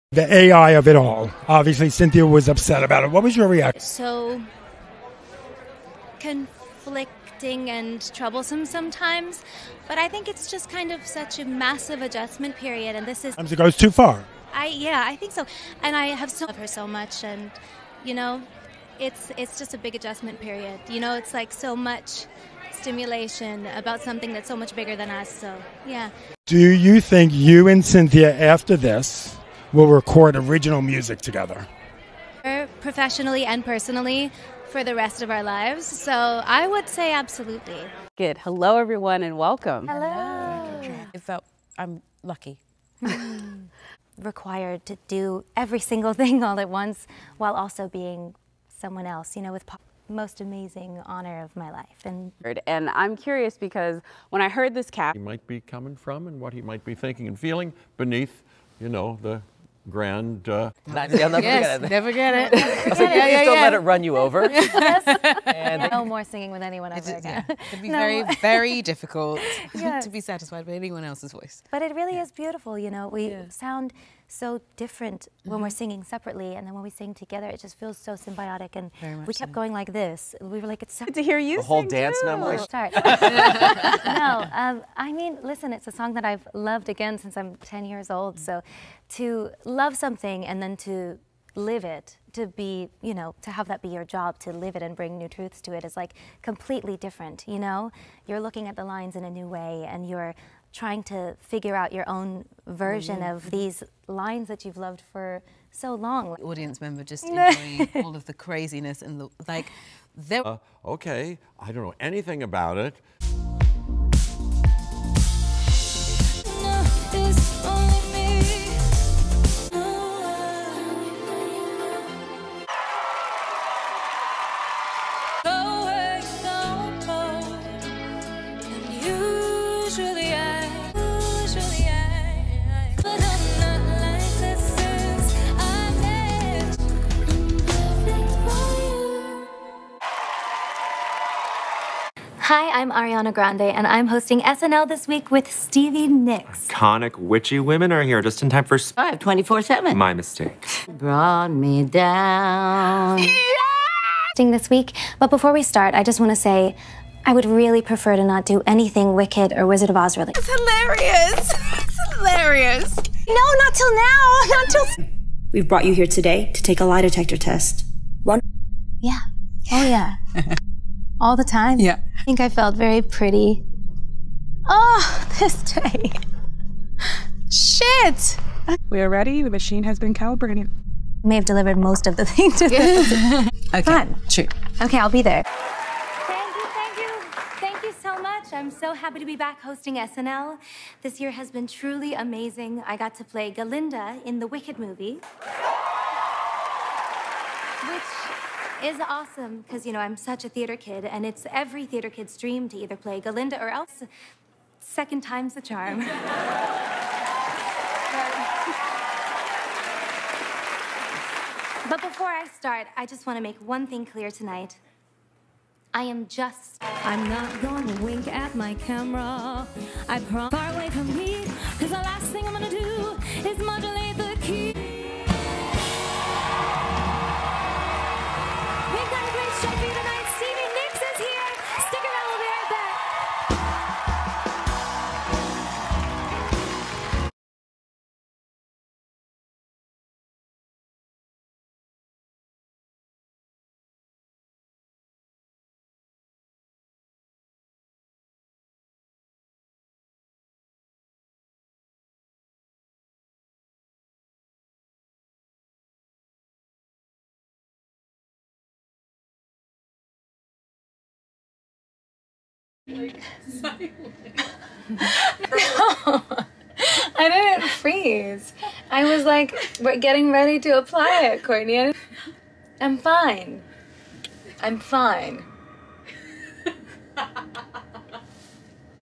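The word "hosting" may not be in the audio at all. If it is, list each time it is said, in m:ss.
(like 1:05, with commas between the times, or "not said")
2:24, 3:09.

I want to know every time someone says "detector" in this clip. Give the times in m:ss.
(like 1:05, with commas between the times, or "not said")
2:47.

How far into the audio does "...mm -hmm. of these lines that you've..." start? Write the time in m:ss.
1:43.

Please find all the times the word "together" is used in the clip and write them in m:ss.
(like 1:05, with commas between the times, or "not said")
0:31, 1:17.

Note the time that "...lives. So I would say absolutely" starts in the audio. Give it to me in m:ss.
0:35.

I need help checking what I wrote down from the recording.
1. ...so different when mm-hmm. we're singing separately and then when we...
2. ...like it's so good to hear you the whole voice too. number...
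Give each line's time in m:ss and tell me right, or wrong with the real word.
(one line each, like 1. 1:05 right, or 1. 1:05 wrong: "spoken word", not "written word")
1. 1:14 right
2. 1:20 wrong: "dance", not "voice".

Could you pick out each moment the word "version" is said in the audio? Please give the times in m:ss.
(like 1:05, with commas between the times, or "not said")
1:42.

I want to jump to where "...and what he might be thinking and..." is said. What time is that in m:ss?
0:56.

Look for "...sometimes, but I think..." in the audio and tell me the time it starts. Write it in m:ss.
0:08.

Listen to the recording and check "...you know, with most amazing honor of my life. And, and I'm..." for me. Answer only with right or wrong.
right.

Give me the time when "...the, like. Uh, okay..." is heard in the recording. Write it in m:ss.
1:49.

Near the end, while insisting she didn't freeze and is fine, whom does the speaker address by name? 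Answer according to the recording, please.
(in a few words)
Courtney.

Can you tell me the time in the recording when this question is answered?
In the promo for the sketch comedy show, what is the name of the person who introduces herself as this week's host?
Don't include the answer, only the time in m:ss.
2:22.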